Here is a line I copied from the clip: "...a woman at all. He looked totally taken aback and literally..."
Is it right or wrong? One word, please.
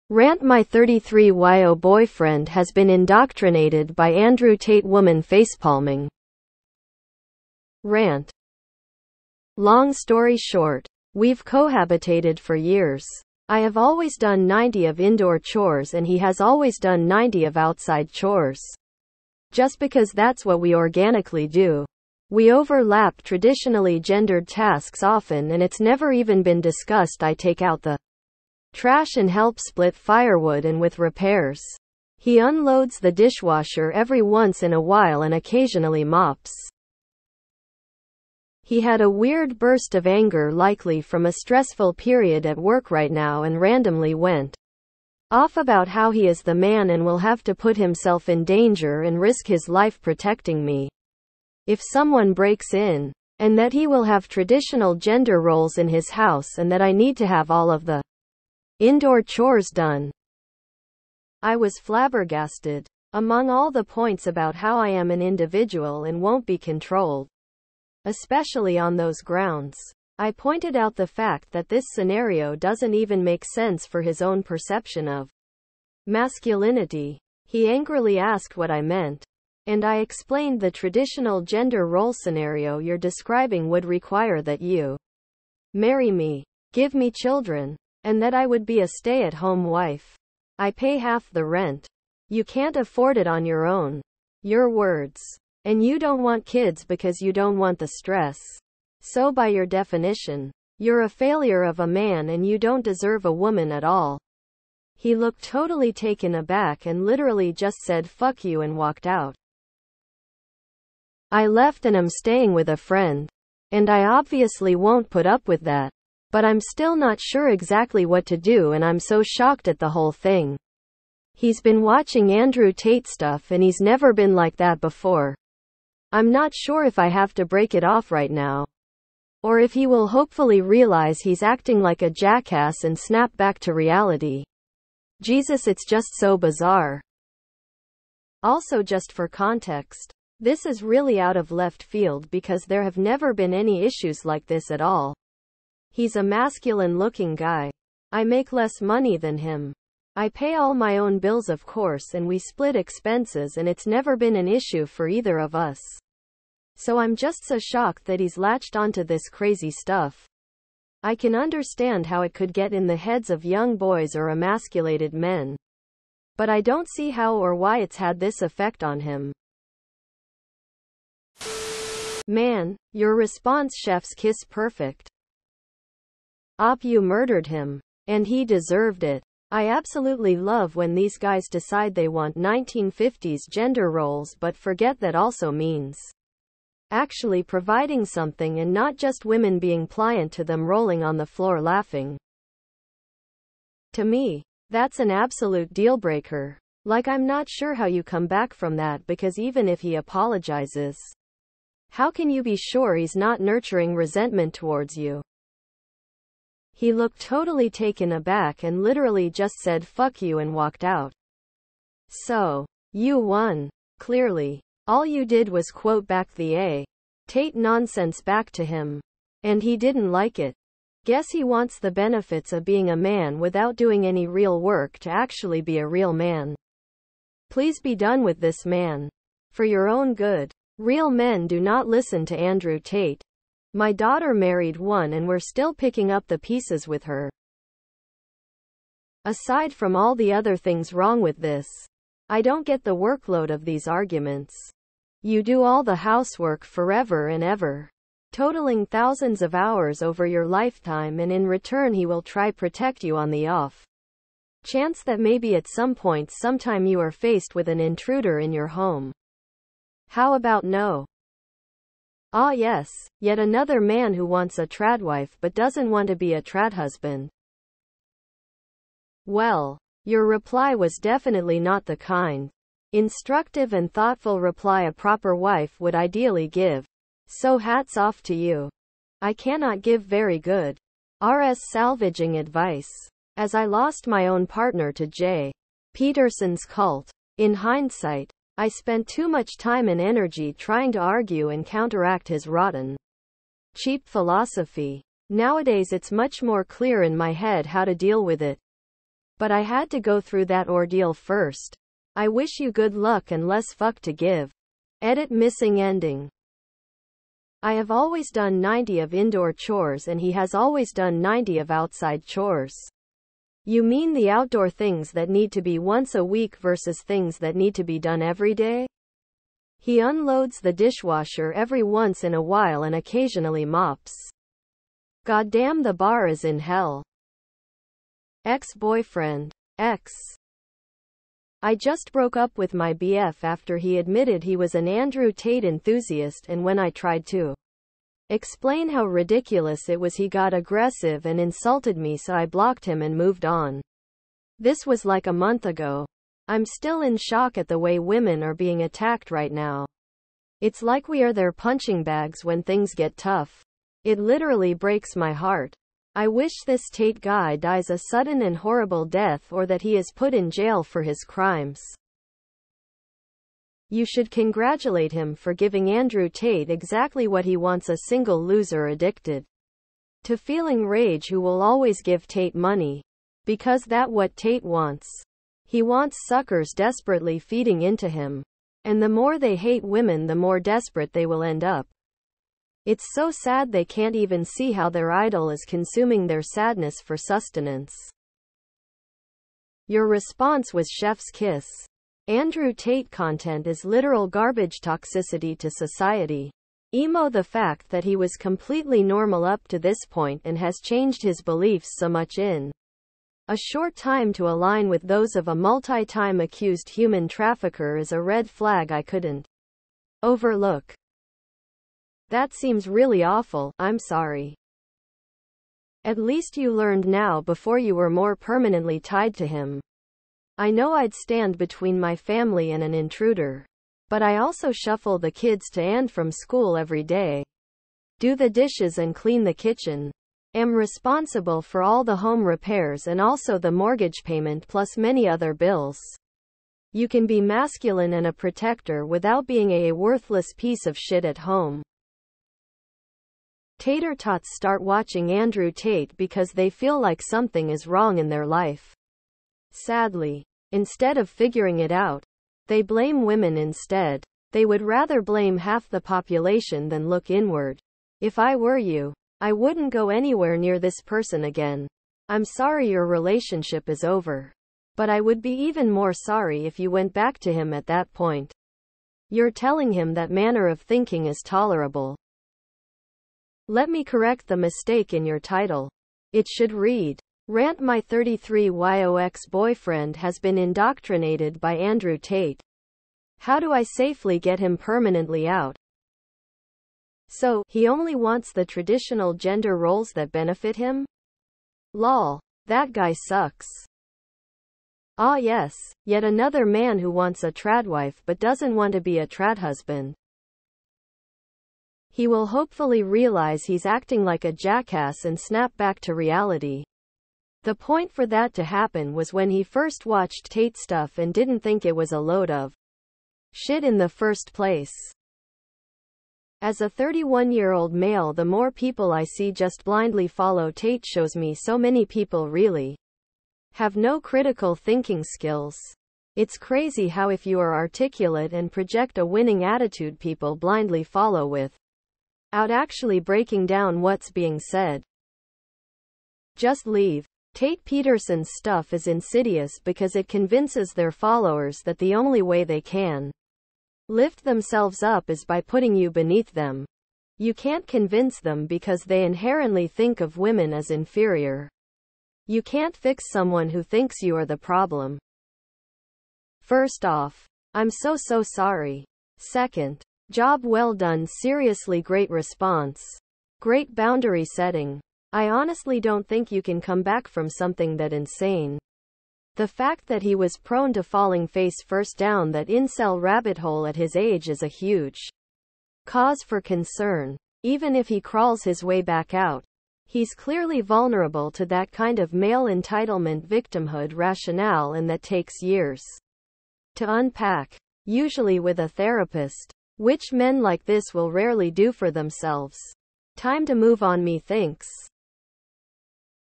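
right.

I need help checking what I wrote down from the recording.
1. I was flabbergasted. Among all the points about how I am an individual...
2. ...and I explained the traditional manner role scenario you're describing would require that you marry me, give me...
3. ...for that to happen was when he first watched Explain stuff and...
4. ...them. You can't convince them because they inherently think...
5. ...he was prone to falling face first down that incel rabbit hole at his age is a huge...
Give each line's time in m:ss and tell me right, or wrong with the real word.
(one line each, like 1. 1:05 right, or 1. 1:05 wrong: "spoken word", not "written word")
1. 1:01 right
2. 1:19 wrong: "gender", not "manner"
3. 8:28 wrong: "Tate", not "Explain"
4. 9:06 right
5. 9:30 right.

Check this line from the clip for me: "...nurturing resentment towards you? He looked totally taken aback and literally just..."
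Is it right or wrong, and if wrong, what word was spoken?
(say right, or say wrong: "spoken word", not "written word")
right.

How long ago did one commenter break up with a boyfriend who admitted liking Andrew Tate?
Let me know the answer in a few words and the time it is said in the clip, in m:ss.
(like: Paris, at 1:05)
A month ago, at 5:45.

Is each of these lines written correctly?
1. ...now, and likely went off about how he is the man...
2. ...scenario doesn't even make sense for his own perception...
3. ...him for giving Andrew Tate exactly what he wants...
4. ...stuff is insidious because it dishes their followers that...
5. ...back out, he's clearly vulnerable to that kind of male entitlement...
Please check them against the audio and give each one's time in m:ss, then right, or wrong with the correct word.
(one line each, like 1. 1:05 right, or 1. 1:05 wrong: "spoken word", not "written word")
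1. 0:43 wrong: "randomly", not "likely"
2. 1:11 right
3. 6:05 right
4. 8:58 wrong: "convinces", not "dishes"
5. 9:39 right.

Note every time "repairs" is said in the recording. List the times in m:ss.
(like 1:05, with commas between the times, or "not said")
0:30, 7:12.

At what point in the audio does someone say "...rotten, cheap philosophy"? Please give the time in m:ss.
4:52.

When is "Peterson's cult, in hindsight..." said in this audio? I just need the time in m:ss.
4:45.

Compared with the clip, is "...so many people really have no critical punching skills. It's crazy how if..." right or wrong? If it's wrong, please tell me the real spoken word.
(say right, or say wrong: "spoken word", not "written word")
wrong: "thinking", not "punching".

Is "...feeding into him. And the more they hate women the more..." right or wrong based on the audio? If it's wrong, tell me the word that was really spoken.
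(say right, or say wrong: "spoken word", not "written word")
right.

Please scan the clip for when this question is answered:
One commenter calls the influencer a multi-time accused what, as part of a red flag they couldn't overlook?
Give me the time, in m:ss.
6:46.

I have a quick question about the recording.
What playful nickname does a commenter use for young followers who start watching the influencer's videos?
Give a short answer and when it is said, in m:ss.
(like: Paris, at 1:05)
Tater tots, at 7:23.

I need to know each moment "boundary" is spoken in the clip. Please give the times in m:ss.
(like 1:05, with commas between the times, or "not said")
9:23.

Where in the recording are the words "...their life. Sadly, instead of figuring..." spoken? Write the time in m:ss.
7:28.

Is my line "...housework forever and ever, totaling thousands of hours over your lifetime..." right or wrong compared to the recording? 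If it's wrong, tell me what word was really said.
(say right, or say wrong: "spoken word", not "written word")
right.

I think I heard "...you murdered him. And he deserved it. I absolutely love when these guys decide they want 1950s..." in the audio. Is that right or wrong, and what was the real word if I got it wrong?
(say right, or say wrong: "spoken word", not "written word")
right.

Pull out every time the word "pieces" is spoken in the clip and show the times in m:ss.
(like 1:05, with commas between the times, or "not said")
3:56, 7:20.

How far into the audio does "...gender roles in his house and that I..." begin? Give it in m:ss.
0:54.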